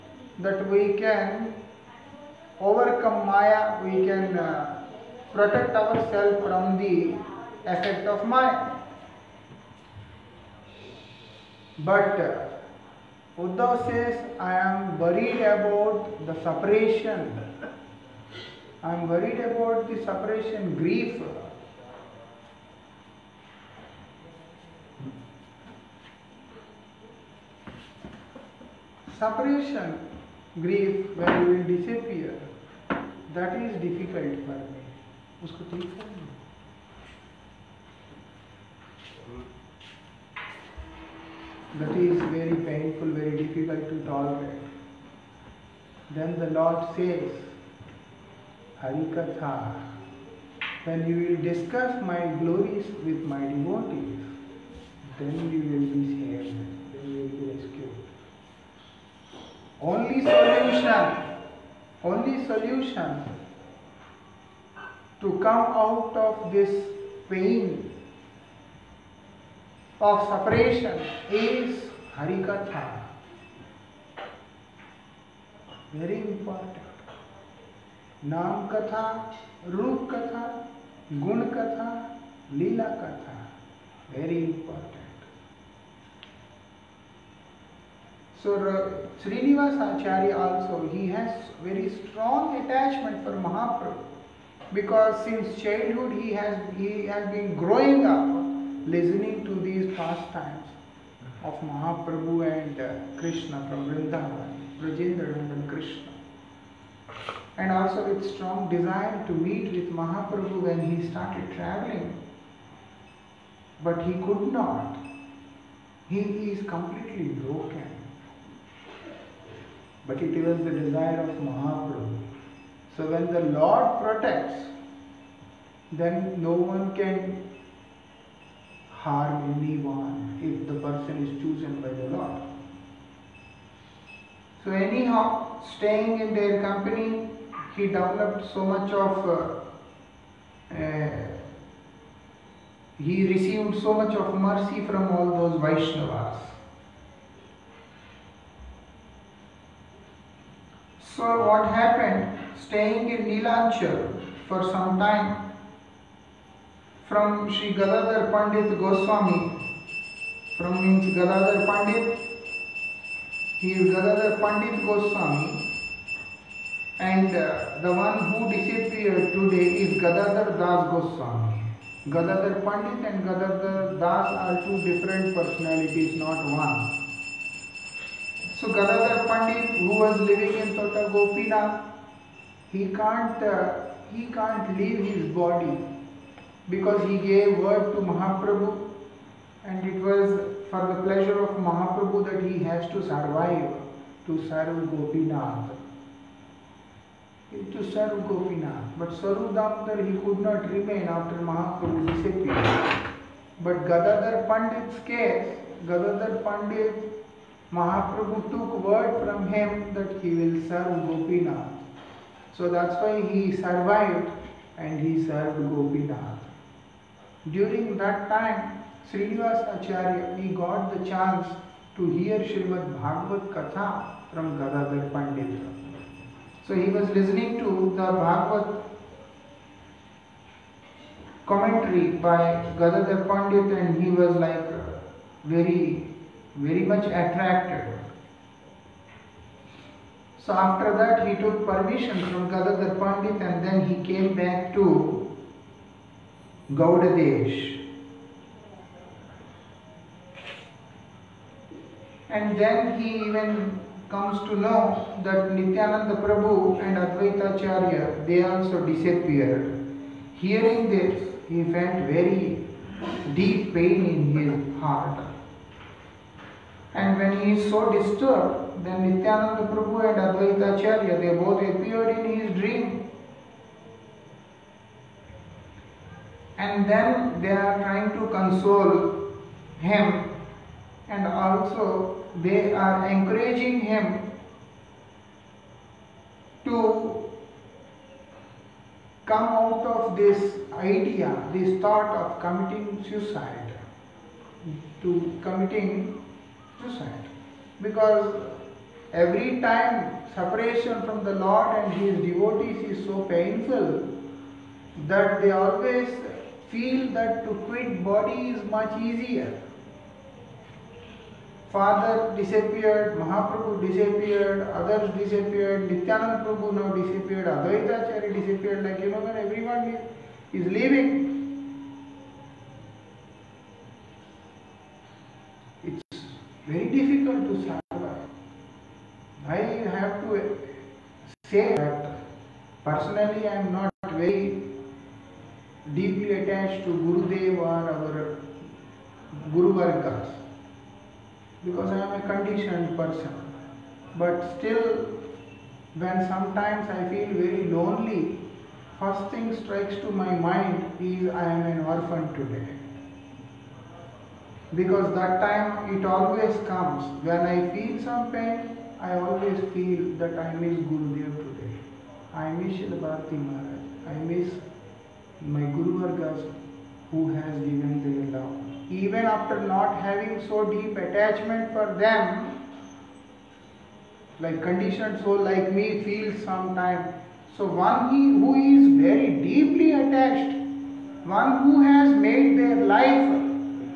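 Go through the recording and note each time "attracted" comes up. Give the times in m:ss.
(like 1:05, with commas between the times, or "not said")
3:57.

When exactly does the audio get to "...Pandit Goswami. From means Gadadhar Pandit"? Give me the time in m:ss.
2:38.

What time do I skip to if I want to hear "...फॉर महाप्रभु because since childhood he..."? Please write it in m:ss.
1:33.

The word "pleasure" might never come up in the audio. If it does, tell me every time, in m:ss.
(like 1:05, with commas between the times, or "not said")
3:11.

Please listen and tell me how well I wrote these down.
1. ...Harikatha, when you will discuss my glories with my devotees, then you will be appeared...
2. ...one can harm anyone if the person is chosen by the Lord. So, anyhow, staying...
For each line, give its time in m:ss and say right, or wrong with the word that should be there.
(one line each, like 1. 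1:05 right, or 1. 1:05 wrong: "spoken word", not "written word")
1. 0:48 wrong: "saved", not "appeared"
2. 2:06 right.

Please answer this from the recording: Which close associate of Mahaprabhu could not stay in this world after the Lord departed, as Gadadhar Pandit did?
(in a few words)
Swarup Damodar.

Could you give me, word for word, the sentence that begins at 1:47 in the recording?
And also with strong desire to meet with Mahaprabhu when he started traveling.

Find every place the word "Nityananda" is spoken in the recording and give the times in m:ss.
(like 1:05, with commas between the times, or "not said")
4:15, 4:29, 5:15.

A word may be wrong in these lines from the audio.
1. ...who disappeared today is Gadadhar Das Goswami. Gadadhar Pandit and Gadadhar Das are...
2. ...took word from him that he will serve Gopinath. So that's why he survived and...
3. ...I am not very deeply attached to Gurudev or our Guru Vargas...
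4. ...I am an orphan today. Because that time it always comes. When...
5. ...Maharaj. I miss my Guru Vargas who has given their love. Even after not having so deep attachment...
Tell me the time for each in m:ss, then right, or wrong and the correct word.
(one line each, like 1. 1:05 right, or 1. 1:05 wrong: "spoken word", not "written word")
1. 2:48 right
2. 3:28 right
3. 5:33 right
4. 5:51 right
5. 6:03 right.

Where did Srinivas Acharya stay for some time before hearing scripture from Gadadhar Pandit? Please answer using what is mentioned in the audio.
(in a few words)
Nilanchal.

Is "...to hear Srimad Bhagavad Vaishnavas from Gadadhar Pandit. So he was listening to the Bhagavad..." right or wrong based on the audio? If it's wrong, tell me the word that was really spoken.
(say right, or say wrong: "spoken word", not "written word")
wrong: "Katha", not "Vaishnavas".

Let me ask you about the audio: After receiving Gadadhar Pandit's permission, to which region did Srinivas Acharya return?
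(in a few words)
Gaudadesh.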